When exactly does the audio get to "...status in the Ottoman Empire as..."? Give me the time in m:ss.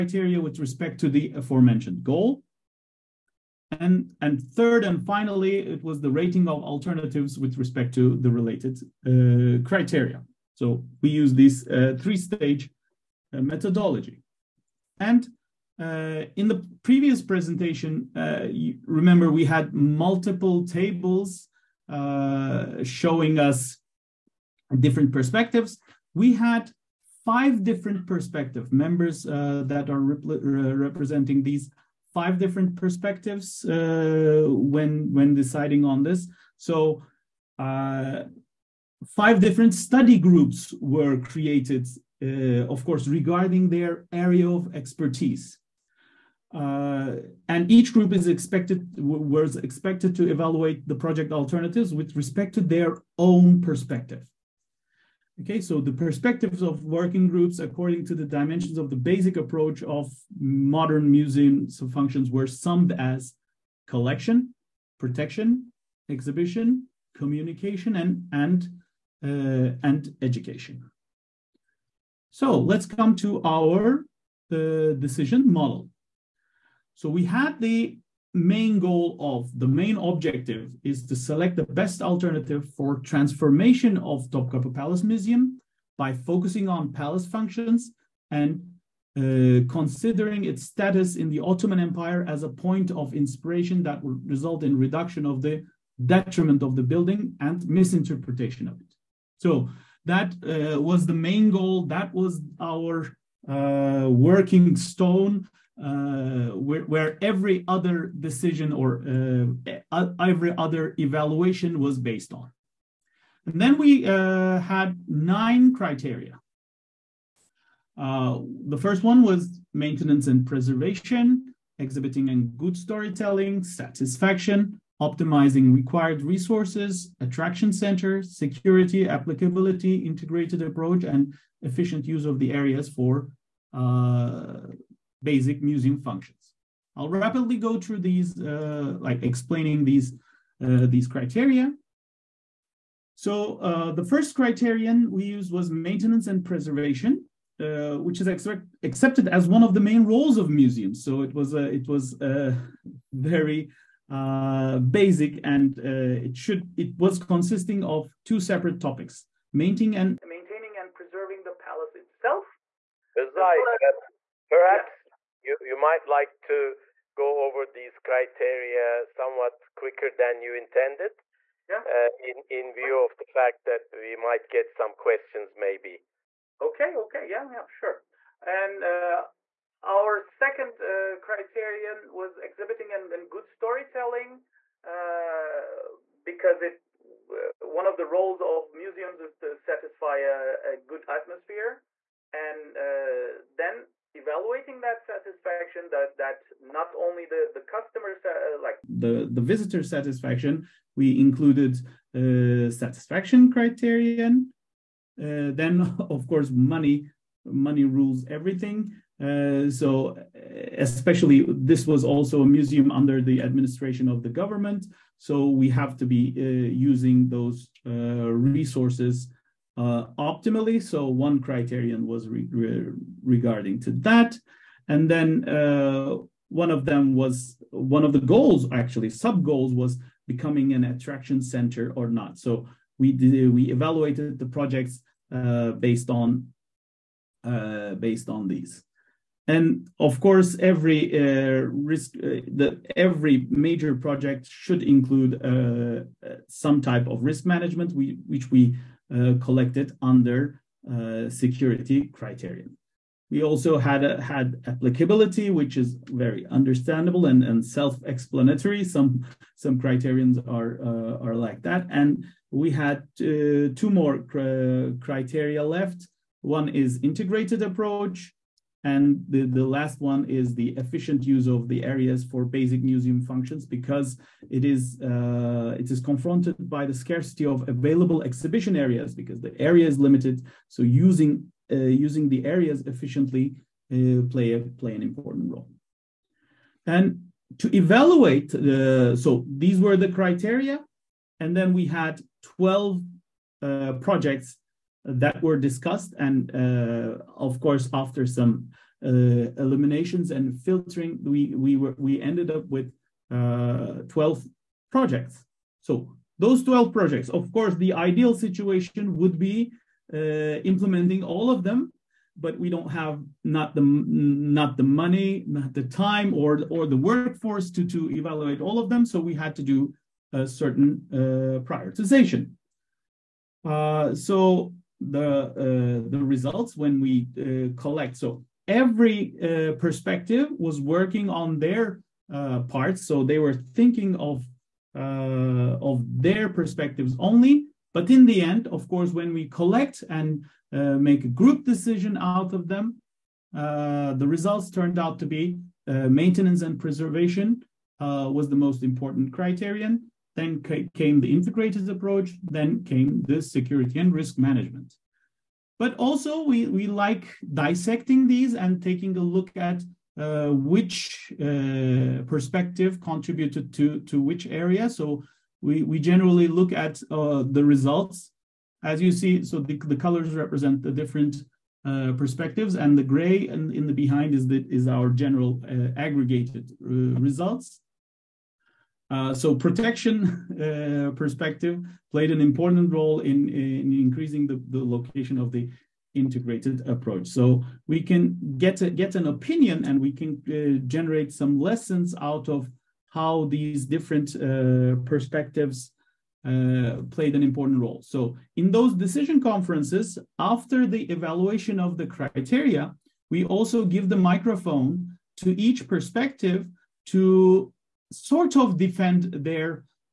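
1:30.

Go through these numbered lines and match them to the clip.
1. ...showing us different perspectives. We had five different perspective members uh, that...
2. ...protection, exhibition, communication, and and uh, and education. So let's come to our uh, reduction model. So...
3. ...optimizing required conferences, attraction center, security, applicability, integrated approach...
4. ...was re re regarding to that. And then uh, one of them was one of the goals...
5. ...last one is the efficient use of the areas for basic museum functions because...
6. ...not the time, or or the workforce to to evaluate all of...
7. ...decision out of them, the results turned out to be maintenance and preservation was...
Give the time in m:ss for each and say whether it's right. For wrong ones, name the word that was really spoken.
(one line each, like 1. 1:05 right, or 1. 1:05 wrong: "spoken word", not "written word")
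1. 0:22 right
2. 1:04 wrong: "decision", not "reduction"
3. 2:04 wrong: "resources", not "conferences"
4. 3:42 right
5. 4:29 right
6. 5:15 right
7. 5:41 right.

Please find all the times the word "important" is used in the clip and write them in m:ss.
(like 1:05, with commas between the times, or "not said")
4:45, 5:48, 6:22, 6:37.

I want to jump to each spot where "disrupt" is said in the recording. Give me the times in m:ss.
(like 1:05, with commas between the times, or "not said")
not said.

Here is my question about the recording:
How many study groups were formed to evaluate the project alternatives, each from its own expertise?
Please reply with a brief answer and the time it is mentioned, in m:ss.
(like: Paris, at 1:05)
5, at 0:39.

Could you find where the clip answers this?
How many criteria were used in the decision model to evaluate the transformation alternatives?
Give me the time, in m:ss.
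1:55.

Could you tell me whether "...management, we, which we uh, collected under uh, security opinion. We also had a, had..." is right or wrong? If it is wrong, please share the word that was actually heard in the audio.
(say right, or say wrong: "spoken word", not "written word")
wrong: "criterion", not "opinion".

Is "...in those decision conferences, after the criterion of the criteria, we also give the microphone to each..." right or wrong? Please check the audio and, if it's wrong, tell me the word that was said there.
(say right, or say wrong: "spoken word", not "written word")
wrong: "evaluation", not "criterion".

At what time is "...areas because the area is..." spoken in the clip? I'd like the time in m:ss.
4:38.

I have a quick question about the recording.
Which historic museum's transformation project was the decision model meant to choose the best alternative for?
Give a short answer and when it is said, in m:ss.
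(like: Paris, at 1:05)
Topkapi Palace Museum, at 1:24.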